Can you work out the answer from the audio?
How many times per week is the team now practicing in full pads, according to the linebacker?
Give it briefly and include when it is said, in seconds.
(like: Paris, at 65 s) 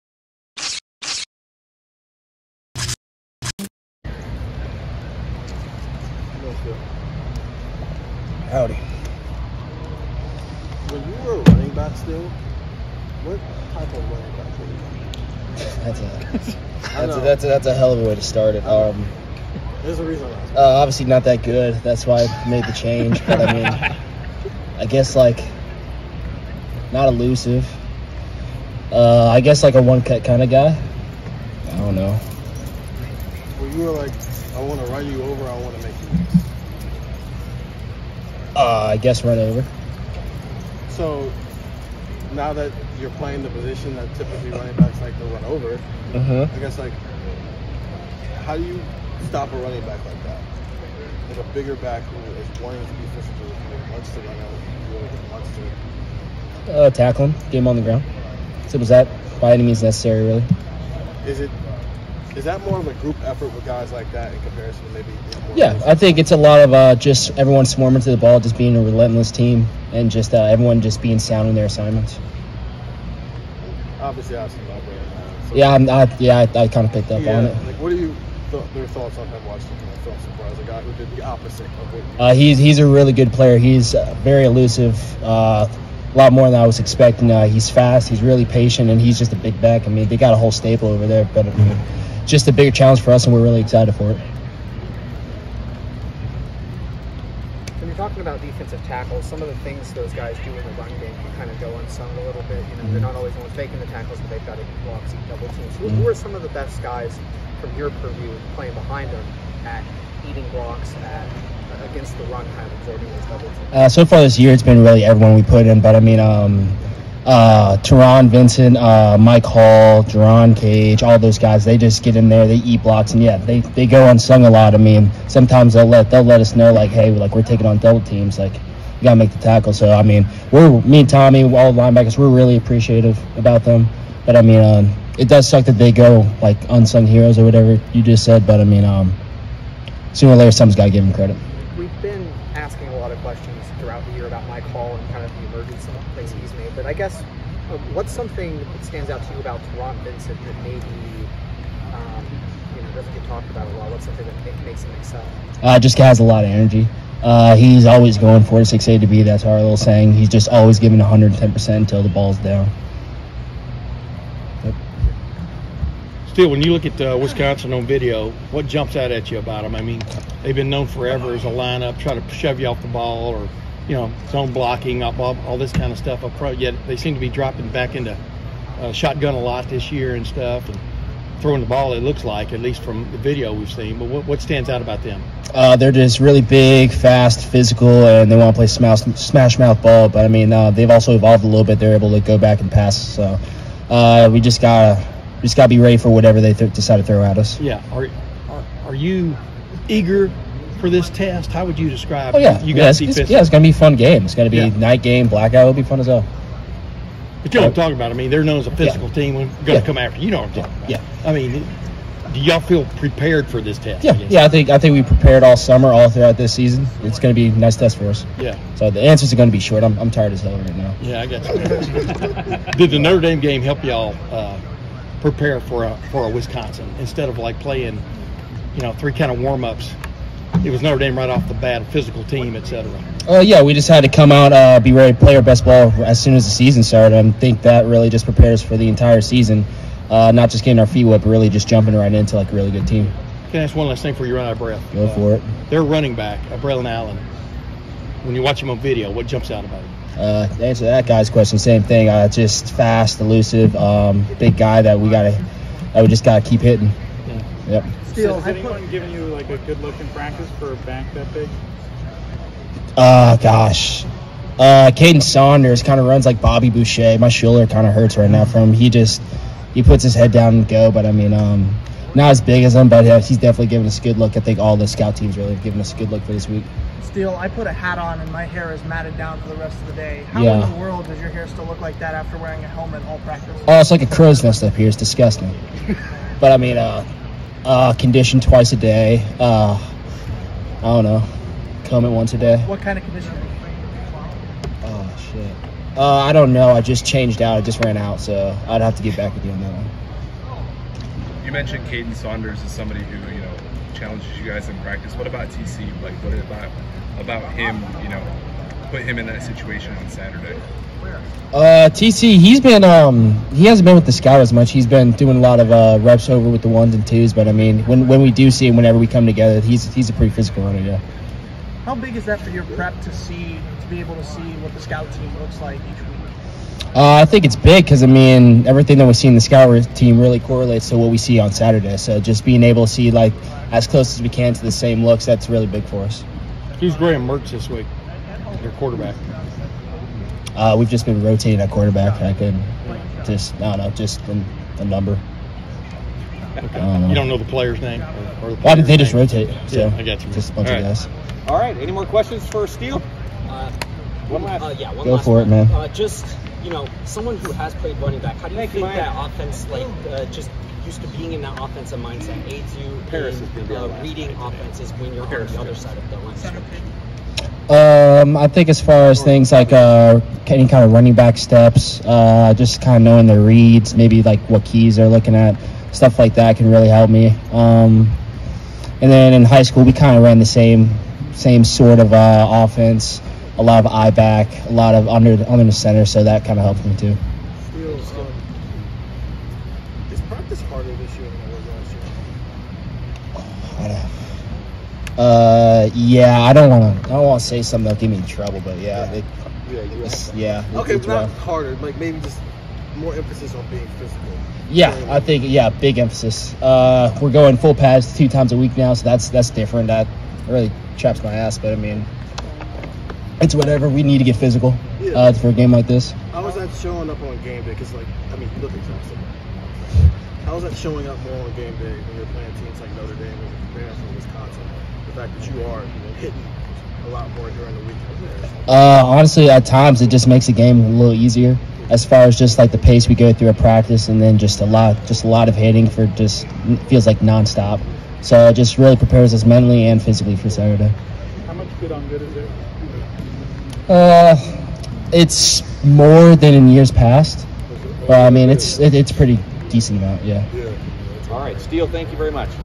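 2, at 408 s.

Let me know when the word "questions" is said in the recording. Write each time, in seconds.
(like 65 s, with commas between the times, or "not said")
143 s, 251 s, 352 s.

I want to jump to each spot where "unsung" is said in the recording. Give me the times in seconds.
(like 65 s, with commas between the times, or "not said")
101 s, 124 s, 136 s.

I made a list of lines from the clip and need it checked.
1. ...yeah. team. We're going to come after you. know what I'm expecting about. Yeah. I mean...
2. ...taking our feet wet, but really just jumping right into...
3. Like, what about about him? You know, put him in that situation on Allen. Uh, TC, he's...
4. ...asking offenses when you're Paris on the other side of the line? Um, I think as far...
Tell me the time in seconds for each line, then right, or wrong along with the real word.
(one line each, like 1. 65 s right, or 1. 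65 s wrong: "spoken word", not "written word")
1. 209 s wrong: "talking", not "expecting"
2. 240 s wrong: "getting", not "taking"
3. 306 s wrong: "Saturday", not "Allen"
4. 364 s wrong: "reading", not "asking".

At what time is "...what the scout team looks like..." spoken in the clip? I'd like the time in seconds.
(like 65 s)
324 s.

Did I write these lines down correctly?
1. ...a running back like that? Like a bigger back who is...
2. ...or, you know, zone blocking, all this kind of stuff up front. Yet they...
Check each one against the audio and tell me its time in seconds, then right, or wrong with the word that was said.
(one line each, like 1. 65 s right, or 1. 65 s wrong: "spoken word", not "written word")
1. 49 s right
2. 173 s right.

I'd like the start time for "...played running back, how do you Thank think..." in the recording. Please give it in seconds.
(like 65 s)
357 s.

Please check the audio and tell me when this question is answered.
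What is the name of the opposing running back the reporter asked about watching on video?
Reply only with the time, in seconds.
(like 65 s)
246 s.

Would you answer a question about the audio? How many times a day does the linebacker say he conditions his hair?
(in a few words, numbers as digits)
2.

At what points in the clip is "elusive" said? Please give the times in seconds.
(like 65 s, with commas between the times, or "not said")
27 s, 84 s, 253 s.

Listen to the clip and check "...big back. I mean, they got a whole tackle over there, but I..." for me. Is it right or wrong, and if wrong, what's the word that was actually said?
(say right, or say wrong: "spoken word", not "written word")
wrong: "staple", not "tackle".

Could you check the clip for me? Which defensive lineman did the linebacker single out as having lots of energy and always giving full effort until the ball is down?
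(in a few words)
Taron Vincent.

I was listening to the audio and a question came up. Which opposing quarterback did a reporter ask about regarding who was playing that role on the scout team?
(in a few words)
Graham Mertz.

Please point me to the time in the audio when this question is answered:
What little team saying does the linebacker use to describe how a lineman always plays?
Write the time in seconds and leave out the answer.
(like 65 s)
158 s.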